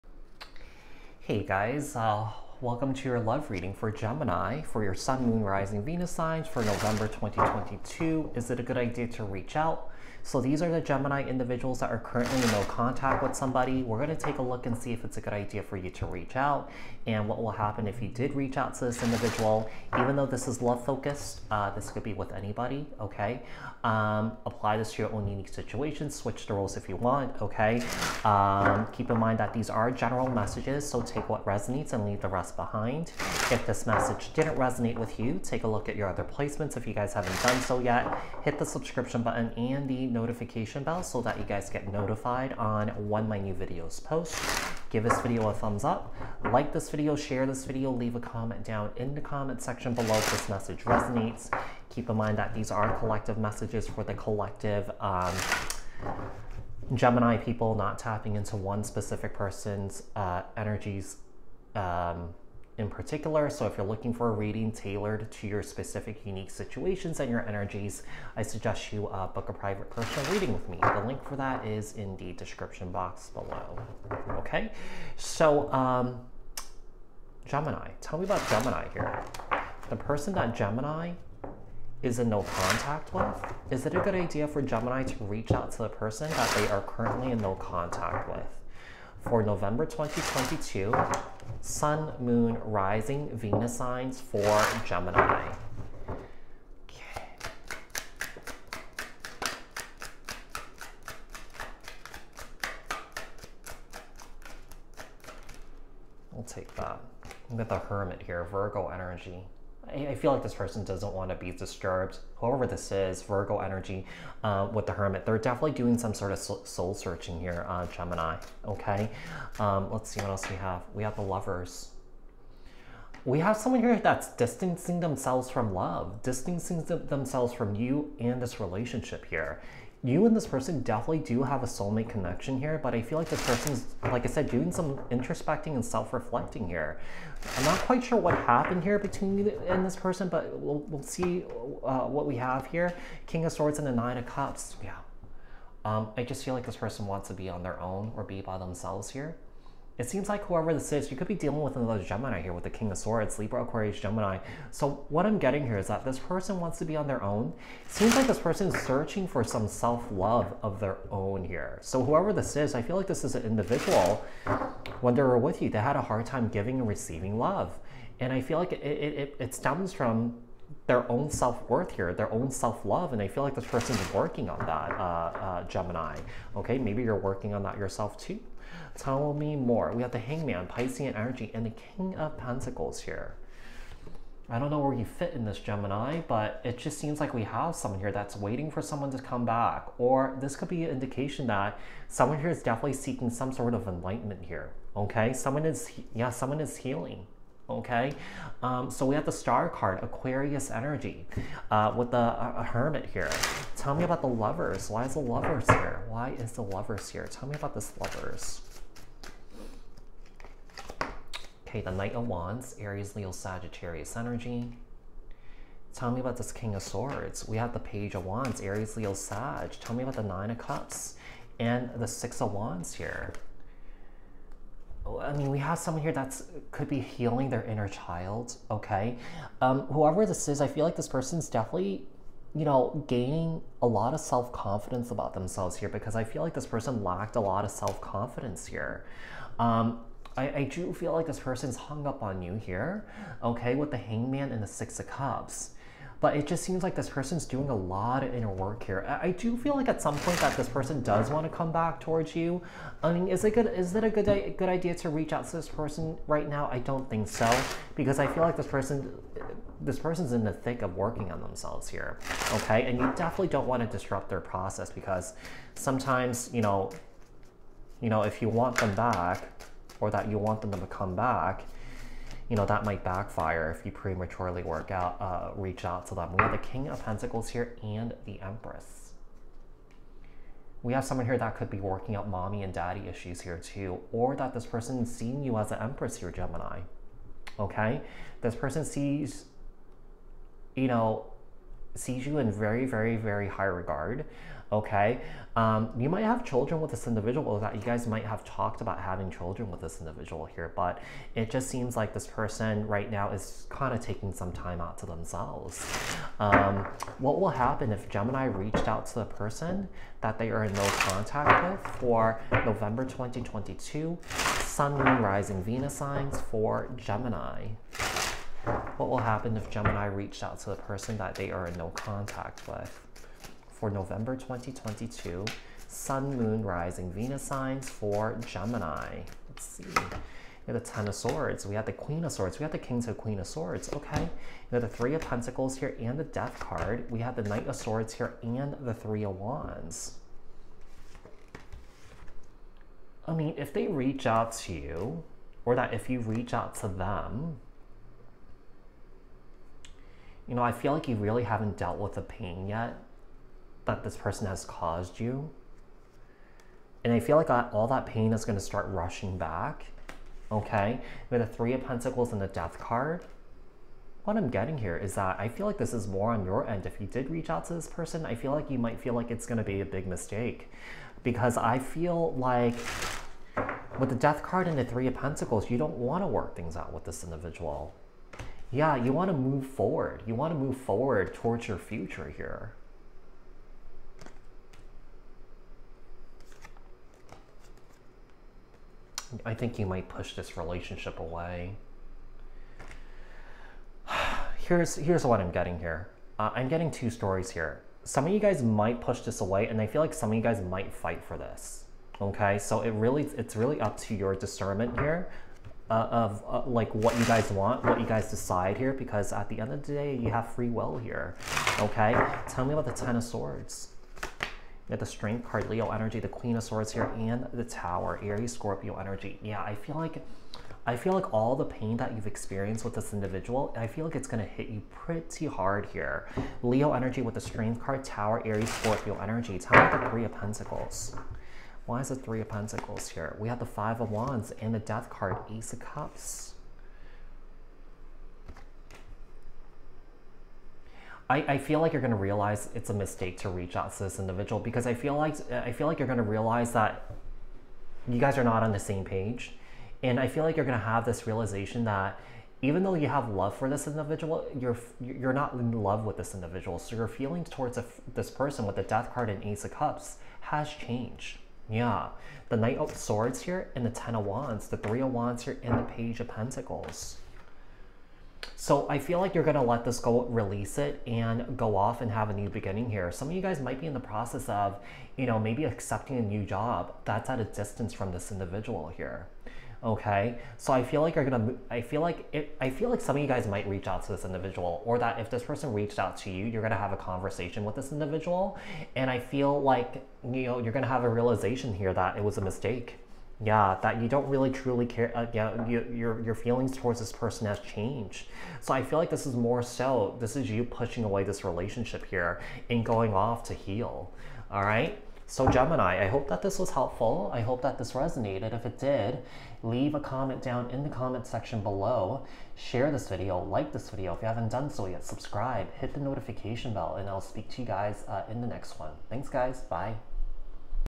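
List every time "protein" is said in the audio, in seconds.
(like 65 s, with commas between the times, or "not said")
not said.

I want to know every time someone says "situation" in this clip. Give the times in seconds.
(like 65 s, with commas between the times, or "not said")
25 s, 66 s.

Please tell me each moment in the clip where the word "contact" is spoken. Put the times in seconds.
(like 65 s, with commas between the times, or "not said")
12 s, 82 s, 87 s, 310 s, 321 s.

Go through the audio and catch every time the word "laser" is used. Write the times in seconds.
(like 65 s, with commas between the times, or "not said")
not said.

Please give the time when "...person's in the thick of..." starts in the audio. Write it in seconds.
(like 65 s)
259 s.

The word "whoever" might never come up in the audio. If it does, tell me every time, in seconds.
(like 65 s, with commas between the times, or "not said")
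112 s, 150 s, 162 s, 229 s.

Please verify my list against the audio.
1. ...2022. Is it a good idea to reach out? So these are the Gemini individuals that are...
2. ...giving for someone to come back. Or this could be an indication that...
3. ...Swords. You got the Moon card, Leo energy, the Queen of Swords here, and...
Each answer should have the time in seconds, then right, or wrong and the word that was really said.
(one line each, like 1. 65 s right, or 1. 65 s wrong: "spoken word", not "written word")
1. 7 s right
2. 188 s wrong: "waiting", not "giving"
3. 413 s wrong: "Strength", not "Moon".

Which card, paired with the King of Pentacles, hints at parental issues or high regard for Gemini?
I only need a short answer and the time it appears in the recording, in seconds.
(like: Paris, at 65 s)
The Empress, at 278 s.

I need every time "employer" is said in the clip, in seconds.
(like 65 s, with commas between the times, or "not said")
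not said.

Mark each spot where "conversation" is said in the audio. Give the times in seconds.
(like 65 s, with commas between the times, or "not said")
486 s.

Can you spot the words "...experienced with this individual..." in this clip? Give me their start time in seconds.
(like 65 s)
422 s.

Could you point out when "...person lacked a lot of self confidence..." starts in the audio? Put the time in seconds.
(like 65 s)
236 s.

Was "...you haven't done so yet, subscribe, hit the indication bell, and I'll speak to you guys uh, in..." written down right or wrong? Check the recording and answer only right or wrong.
wrong.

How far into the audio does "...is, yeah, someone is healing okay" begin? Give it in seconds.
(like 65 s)
195 s.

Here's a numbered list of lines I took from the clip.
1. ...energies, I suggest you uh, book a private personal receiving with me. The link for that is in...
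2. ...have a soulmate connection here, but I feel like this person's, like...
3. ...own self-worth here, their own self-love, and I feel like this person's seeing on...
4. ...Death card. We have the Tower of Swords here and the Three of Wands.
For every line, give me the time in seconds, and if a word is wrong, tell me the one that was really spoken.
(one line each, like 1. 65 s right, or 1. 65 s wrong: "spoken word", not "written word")
1. 67 s wrong: "reading", not "receiving"
2. 131 s right
3. 171 s wrong: "working", not "seeing"
4. 336 s wrong: "Knight", not "Tower".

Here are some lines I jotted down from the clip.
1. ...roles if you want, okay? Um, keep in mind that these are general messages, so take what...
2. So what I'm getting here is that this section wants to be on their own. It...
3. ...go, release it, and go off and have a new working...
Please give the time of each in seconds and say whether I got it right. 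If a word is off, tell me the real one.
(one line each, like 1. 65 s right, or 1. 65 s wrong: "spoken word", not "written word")
1. 26 s right
2. 154 s wrong: "person", not "section"
3. 469 s wrong: "beginning", not "working".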